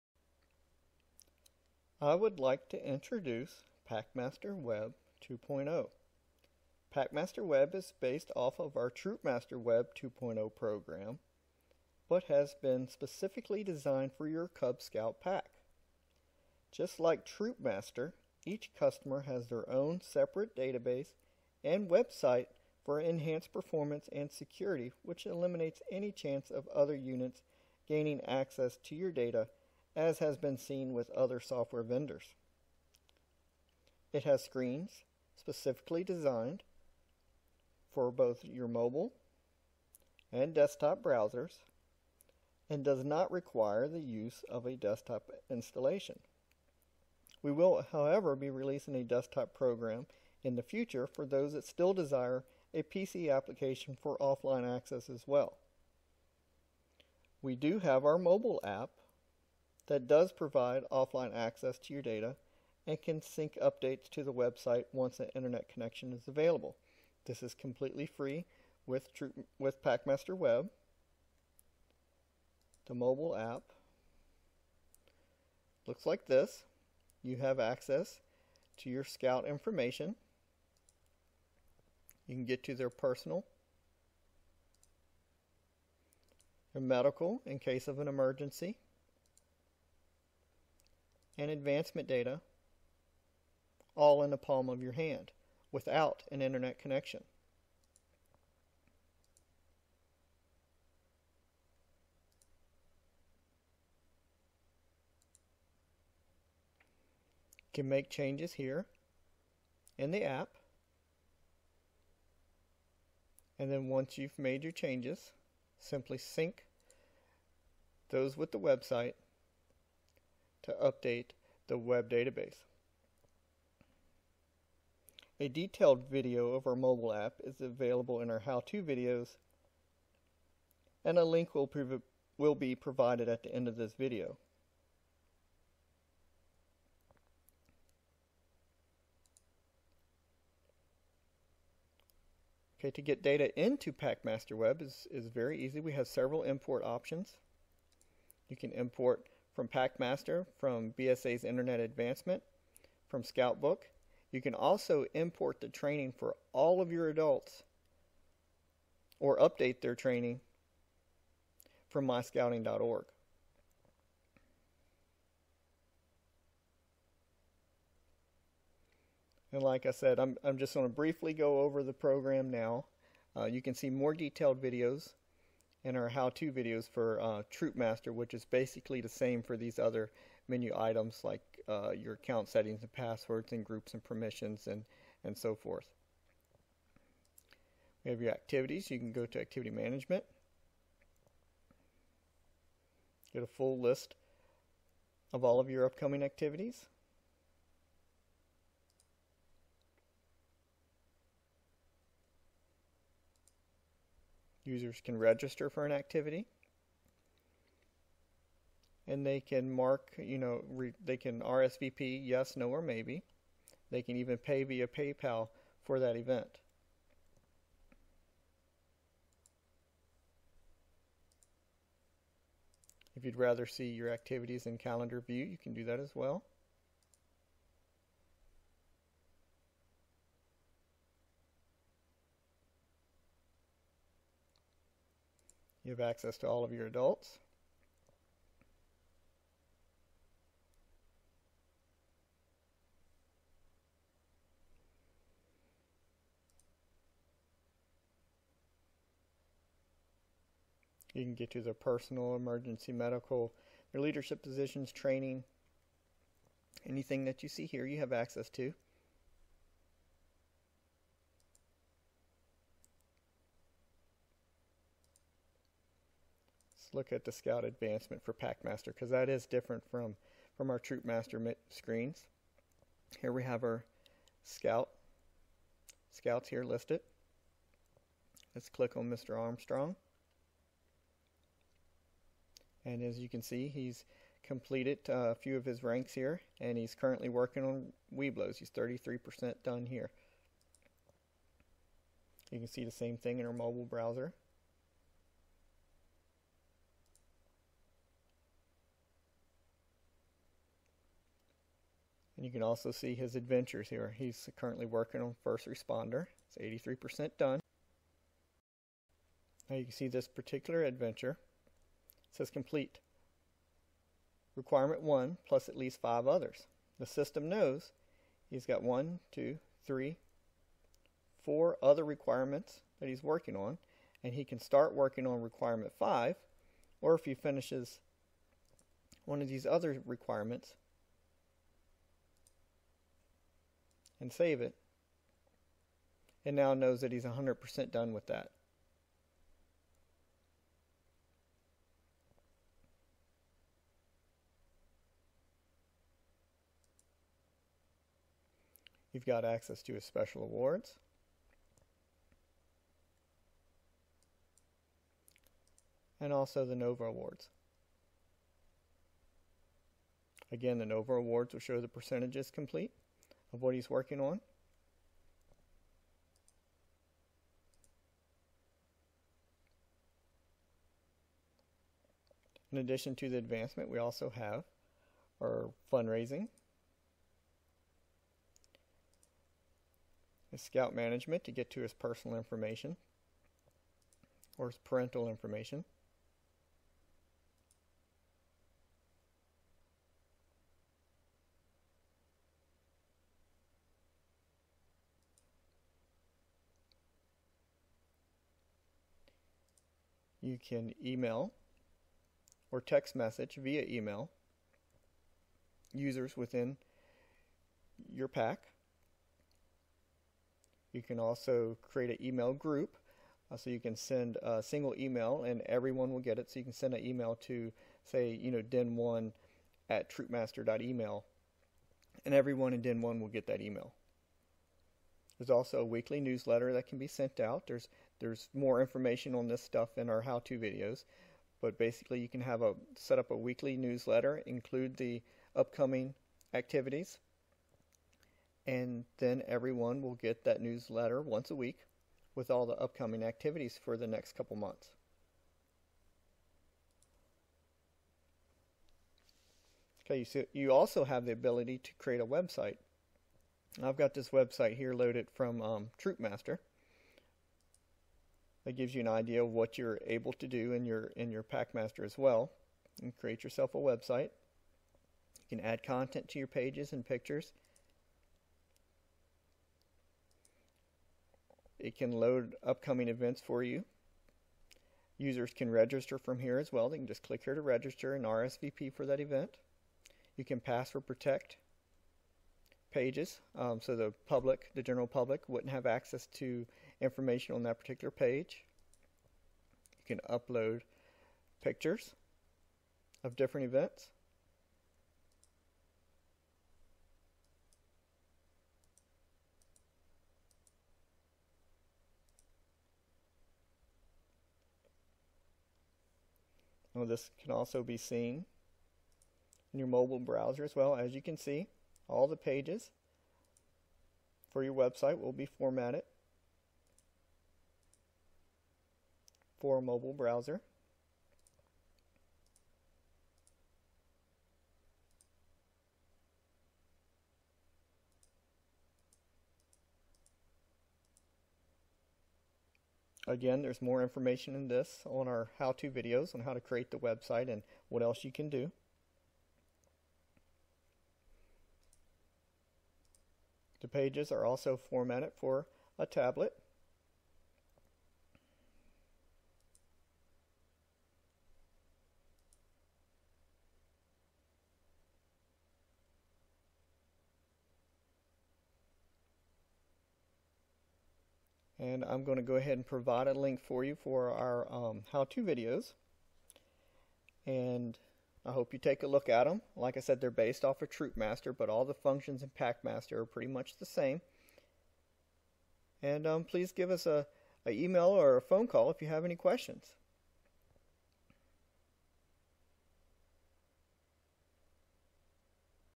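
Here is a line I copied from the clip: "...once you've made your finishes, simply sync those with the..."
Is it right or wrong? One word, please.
wrong.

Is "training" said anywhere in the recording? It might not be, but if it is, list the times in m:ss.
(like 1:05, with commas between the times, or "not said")
2:35, 2:39, 4:14.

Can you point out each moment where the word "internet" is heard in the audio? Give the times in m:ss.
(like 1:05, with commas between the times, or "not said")
1:05, 1:36, 2:31.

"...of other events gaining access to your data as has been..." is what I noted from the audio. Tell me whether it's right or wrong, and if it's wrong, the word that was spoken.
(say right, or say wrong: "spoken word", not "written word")
wrong: "units", not "events".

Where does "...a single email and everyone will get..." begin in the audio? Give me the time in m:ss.
6:54.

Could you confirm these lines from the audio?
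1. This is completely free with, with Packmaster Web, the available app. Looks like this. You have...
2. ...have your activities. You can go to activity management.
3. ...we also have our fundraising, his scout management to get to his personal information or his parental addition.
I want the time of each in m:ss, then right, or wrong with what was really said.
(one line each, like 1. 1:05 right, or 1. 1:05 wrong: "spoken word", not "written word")
1. 1:07 wrong: "mobile", not "available"
2. 3:08 right
3. 6:13 wrong: "information", not "addition".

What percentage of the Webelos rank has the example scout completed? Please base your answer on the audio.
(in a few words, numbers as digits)
33%.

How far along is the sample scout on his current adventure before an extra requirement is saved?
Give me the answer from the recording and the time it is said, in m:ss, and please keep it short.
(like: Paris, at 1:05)
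83%, at 5:06.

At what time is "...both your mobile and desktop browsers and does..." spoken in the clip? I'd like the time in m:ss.
0:38.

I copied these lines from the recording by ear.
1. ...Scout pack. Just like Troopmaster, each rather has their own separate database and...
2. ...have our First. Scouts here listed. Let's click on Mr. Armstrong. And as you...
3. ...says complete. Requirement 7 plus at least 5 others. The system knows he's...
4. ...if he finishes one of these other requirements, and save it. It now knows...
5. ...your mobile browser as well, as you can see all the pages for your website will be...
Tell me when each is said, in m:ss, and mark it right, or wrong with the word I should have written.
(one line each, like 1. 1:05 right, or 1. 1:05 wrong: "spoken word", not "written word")
1. 0:14 wrong: "customer", not "rather"
2. 4:33 wrong: "Scout", not "First"
3. 5:12 wrong: "1", not "7"
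4. 5:27 right
5. 8:29 right.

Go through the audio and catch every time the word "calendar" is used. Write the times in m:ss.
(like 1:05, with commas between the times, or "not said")
3:44.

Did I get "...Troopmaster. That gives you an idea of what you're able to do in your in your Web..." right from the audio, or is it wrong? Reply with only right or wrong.
wrong.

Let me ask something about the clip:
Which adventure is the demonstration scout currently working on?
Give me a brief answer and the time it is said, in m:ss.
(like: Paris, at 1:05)
First Responder, at 5:05.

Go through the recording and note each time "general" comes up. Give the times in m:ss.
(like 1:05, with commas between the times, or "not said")
8:04.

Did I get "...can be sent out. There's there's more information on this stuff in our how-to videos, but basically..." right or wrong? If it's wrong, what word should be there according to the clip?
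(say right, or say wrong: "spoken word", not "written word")
right.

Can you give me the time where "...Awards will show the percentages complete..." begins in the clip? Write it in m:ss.
6:01.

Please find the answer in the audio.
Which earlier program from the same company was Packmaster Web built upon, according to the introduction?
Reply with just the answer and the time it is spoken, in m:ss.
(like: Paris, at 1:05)
Troopmaster Web 2.0, at 0:08.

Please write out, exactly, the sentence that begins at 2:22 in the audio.
Okay, to get data into PackmasterWeb is, is very easy.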